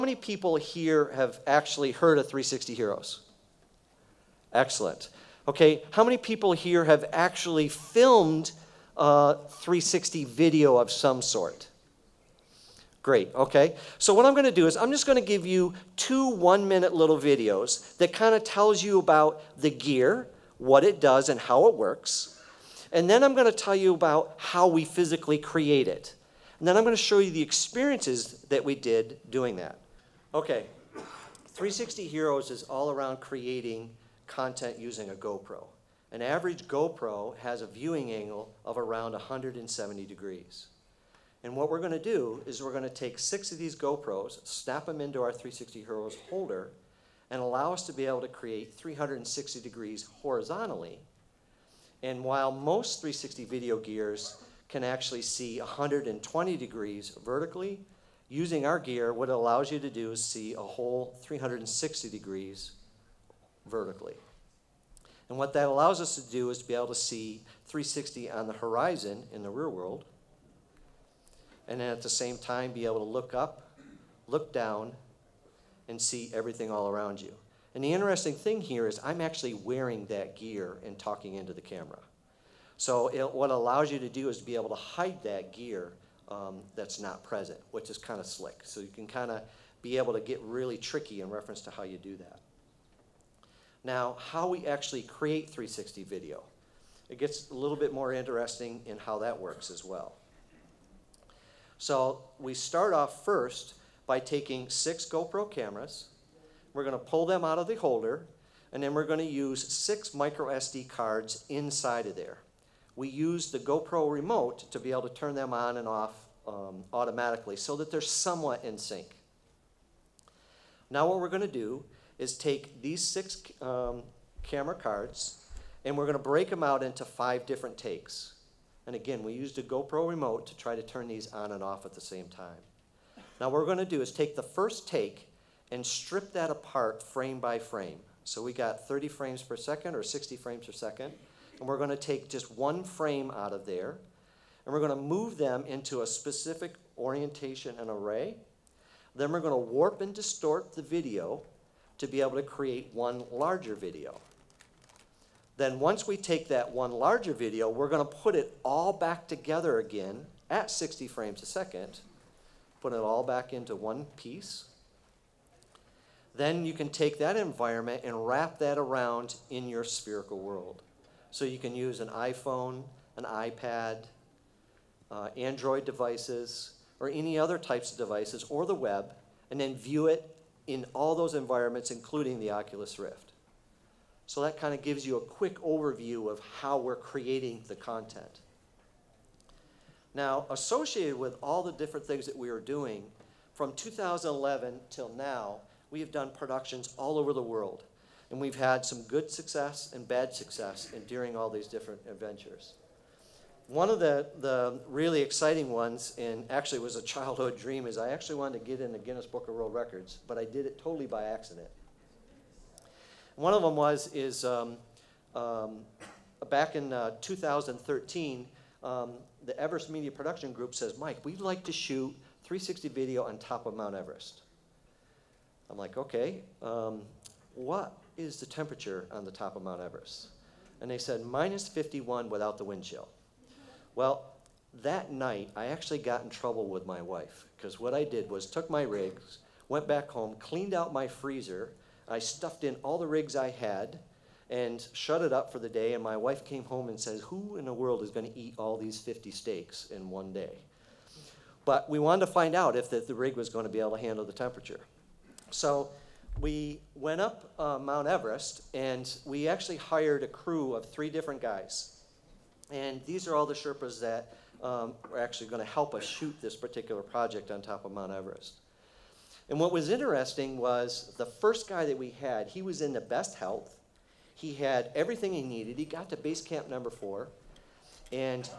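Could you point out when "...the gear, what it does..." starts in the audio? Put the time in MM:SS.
00:19.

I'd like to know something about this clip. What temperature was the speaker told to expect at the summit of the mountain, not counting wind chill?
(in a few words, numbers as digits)
minus 51.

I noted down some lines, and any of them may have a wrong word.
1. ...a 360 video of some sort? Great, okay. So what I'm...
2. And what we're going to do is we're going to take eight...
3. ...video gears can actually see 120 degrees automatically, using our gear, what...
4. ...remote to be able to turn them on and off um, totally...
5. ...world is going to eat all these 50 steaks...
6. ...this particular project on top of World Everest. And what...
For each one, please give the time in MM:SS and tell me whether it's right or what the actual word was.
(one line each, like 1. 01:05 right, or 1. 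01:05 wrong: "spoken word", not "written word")
1. 00:08 right
2. 00:41 wrong: "six", not "eight"
3. 00:53 wrong: "vertically", not "automatically"
4. 01:54 wrong: "automatically", not "totally"
5. 04:07 right
6. 04:26 wrong: "Mount", not "World".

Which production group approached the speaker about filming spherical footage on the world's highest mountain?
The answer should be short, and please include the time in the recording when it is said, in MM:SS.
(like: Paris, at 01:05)
Everest Media Production Group, at 03:39.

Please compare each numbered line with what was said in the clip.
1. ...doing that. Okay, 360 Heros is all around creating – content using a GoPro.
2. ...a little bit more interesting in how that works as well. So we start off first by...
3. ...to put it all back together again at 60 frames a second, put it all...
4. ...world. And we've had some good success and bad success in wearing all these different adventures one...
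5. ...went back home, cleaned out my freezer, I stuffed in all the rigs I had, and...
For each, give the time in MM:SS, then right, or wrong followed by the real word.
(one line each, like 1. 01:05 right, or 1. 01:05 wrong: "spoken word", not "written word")
1. 00:29 right
2. 01:37 right
3. 02:38 right
4. 03:17 wrong: "during", not "wearing"
5. 03:59 right.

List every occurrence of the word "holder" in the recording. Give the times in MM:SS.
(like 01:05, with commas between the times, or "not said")
00:46, 01:47.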